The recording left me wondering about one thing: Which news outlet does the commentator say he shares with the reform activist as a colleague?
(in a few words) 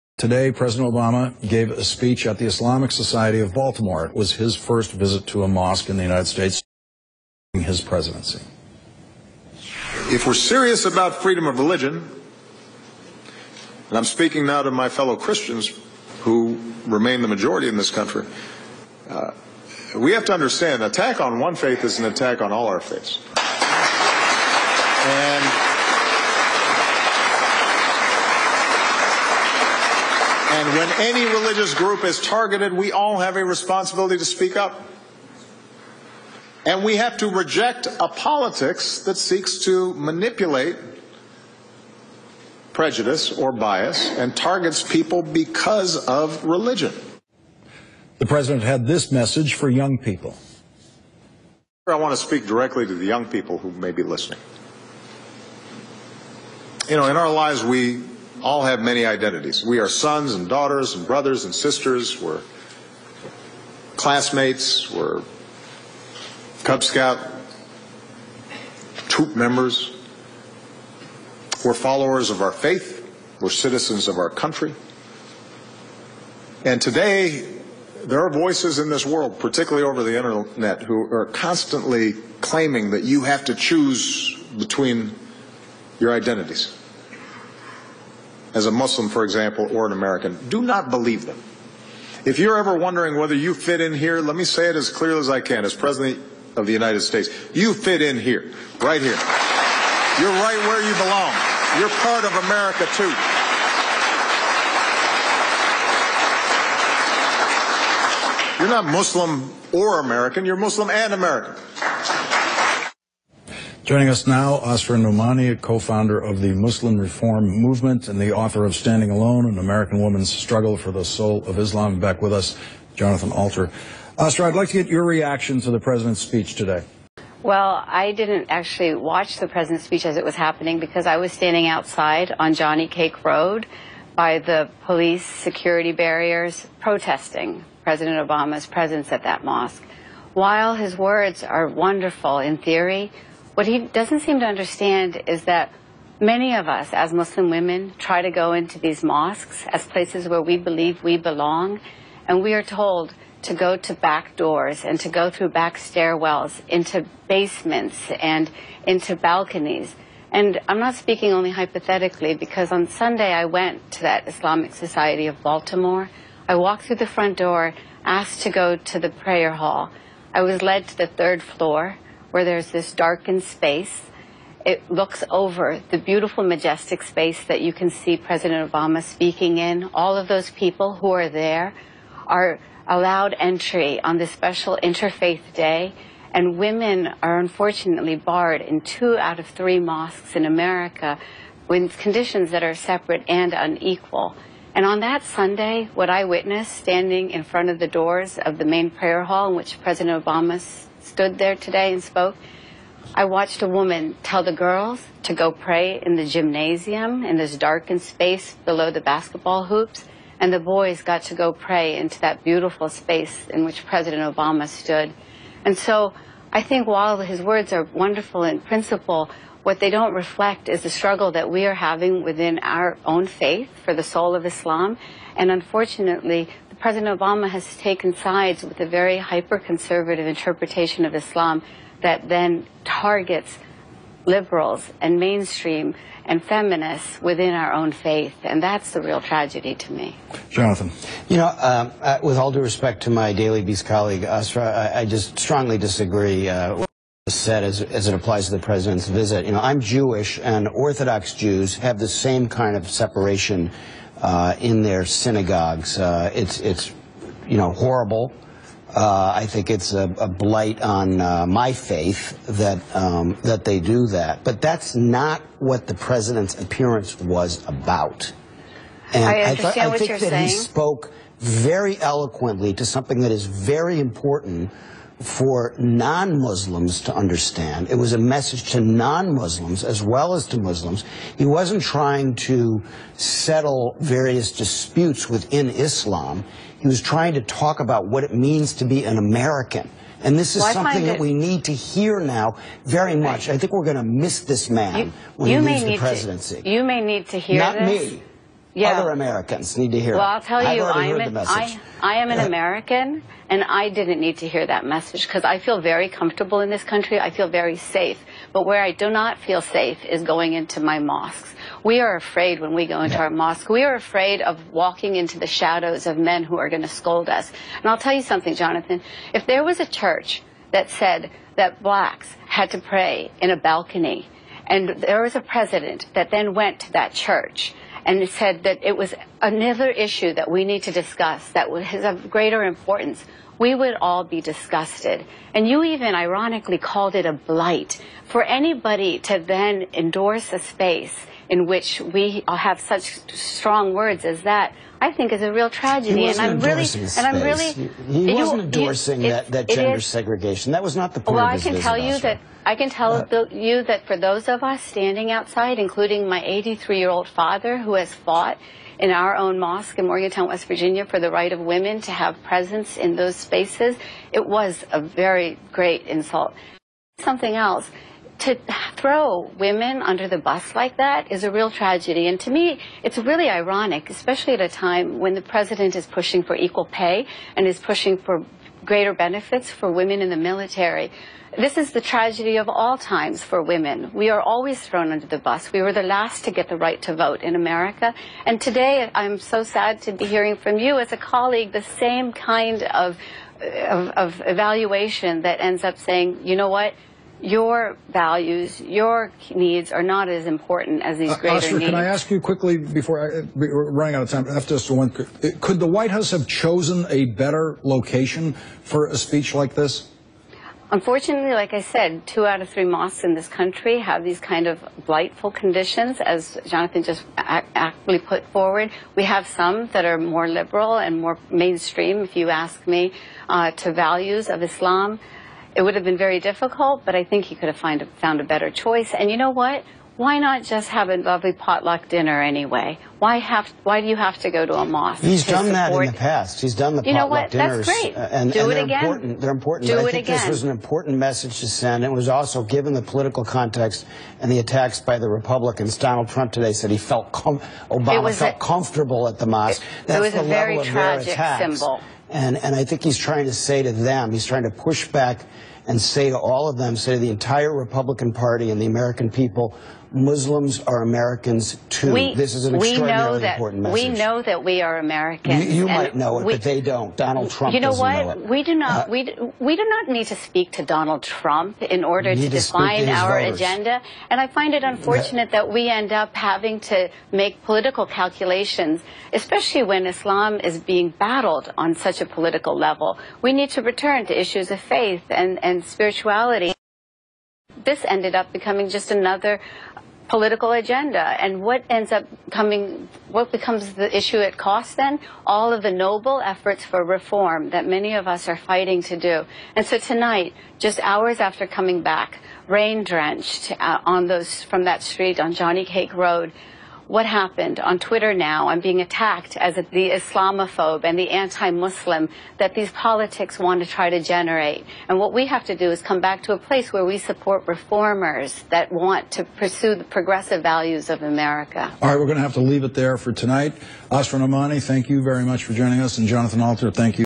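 Daily Beast.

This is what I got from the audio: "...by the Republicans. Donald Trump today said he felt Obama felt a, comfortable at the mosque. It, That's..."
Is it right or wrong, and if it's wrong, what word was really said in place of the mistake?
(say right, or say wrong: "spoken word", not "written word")
right.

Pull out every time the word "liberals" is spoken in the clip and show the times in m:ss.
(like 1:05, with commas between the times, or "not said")
3:54, 7:00.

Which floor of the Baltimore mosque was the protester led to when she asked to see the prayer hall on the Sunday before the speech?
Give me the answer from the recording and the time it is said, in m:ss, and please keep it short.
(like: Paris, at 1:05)
third floor, at 2:51.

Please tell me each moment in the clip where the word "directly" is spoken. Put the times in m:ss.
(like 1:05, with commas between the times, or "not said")
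0:52.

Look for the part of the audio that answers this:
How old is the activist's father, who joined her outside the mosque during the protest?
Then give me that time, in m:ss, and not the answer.
5:56.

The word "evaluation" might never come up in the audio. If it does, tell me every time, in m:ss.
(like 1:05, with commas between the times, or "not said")
6:34.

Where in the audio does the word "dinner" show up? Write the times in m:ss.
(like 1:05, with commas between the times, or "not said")
7:12, 7:17.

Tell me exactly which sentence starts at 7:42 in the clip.
We, this is an extraordinarily important message.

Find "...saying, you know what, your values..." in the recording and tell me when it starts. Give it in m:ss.
6:35.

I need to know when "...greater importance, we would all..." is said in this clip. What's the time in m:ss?
5:32.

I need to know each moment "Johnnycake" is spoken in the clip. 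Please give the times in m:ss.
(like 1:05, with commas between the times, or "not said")
2:12, 8:25.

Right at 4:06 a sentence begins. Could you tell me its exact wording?
Uh, said as, as it applies to the president's visit.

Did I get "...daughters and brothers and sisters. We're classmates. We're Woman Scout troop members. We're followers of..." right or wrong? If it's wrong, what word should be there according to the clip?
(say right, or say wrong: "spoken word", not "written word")
wrong: "Cub", not "Woman".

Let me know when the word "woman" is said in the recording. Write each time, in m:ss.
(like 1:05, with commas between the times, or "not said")
1:59, 3:23.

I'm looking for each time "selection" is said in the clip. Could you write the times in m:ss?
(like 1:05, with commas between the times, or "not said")
not said.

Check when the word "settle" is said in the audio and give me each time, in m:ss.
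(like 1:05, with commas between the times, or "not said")
4:43.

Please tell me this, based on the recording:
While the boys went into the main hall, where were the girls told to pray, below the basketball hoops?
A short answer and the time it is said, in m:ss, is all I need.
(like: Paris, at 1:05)
the gymnasium, at 3:26.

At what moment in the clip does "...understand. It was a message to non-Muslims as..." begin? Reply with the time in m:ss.
4:37.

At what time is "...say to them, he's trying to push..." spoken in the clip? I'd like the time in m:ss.
7:33.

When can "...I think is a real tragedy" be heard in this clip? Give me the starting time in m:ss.
5:45.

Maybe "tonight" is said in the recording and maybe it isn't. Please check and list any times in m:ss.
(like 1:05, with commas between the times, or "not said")
8:19, 8:43.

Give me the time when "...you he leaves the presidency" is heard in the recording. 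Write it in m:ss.
4:55.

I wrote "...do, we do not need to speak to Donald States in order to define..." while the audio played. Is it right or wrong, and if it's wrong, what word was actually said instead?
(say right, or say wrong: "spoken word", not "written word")
wrong: "Trump", not "States".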